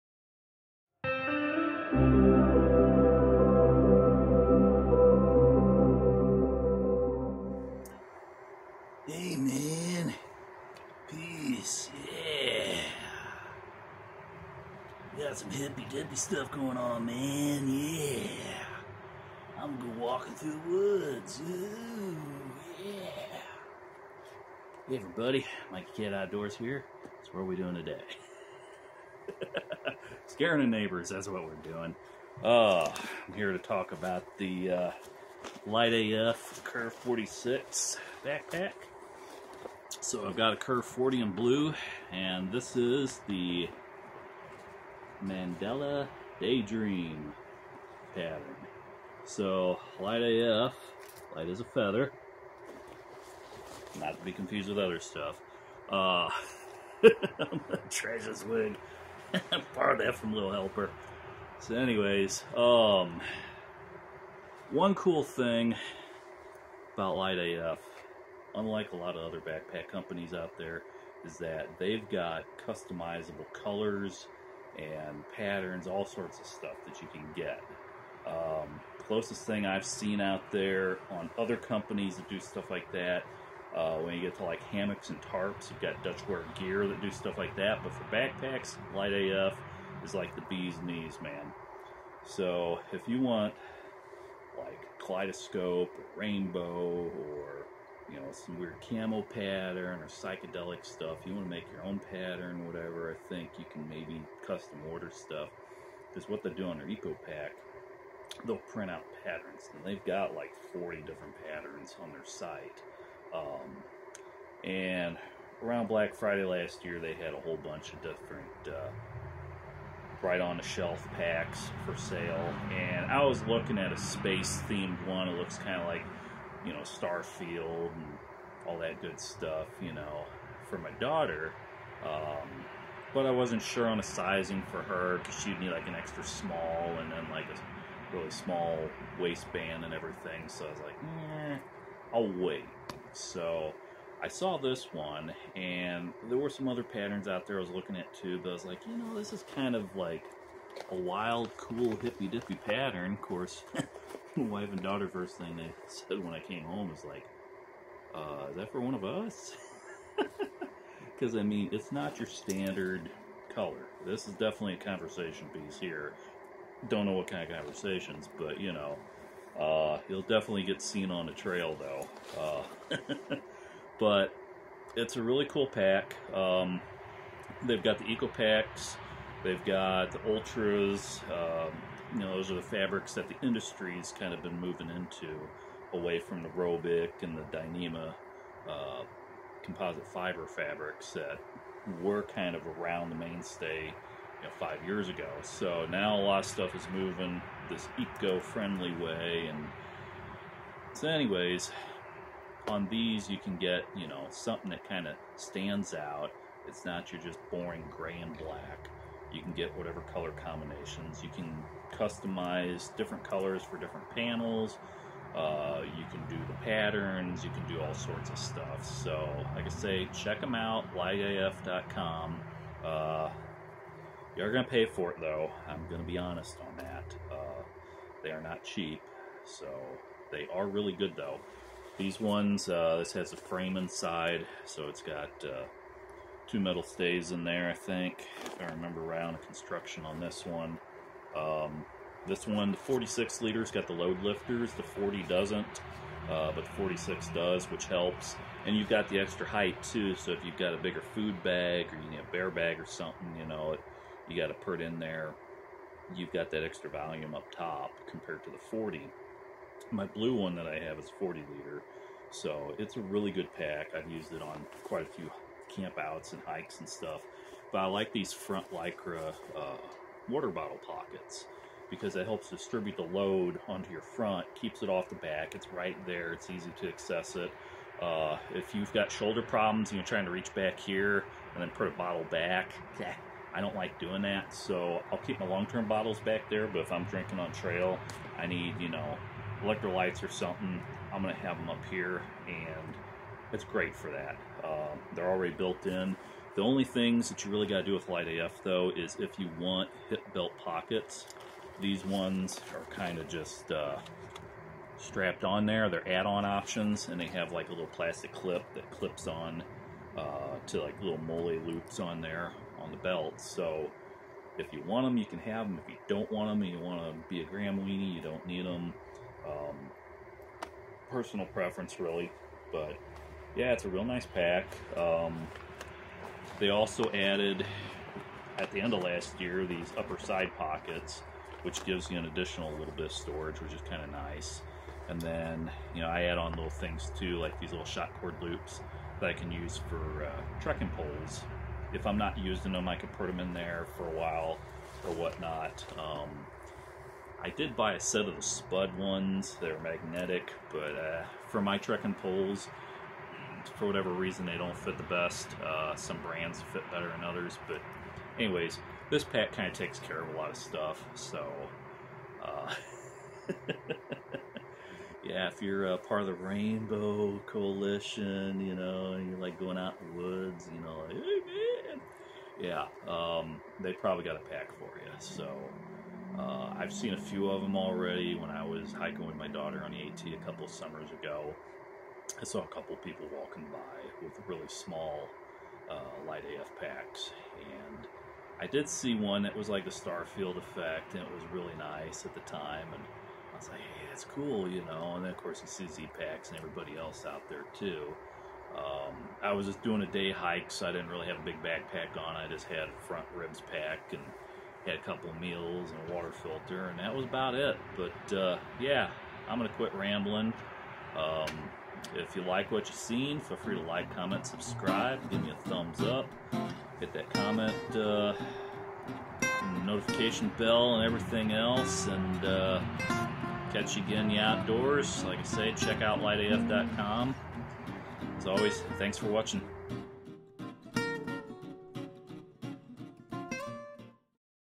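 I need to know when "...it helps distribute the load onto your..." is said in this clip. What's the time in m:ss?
4:32.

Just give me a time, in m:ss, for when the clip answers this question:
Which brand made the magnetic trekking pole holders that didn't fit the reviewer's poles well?
5:48.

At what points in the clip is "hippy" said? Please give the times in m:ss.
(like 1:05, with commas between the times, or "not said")
0:15, 2:31.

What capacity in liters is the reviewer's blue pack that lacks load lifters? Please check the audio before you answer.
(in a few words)
40 liters.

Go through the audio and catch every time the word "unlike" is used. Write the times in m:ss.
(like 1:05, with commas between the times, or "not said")
1:08.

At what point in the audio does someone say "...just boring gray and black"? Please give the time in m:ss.
3:27.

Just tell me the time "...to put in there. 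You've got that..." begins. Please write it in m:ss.
4:14.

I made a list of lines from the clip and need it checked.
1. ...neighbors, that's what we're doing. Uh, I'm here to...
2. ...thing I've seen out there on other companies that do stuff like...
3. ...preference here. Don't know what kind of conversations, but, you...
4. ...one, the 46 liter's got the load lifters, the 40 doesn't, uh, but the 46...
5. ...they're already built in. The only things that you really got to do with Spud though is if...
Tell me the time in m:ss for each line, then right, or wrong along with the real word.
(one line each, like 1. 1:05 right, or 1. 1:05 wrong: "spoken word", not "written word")
1. 0:30 right
2. 1:19 right
3. 2:45 wrong: "piece", not "preference"
4. 4:02 right
5. 4:55 wrong: "LiteAF", not "Spud".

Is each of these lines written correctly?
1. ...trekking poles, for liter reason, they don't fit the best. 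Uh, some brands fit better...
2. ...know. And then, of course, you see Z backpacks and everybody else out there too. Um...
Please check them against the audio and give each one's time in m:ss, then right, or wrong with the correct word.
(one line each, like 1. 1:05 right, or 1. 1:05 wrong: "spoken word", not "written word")
1. 5:51 wrong: "whatever", not "liter"
2. 6:34 wrong: "packs", not "backpacks".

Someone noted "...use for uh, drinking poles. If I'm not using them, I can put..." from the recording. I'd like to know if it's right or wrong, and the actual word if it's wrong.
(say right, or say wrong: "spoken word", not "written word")
wrong: "trekking", not "drinking".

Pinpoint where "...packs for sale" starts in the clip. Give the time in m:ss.
2:01.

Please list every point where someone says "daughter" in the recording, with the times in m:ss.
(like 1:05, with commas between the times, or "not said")
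2:10, 2:34, 6:19.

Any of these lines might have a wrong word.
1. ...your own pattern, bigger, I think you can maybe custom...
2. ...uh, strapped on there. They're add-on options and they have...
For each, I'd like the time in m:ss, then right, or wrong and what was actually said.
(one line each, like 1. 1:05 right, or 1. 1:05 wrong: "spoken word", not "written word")
1. 1:41 wrong: "whatever", not "bigger"
2. 5:03 right.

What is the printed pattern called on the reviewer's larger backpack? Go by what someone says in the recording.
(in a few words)
Mandala Daydream.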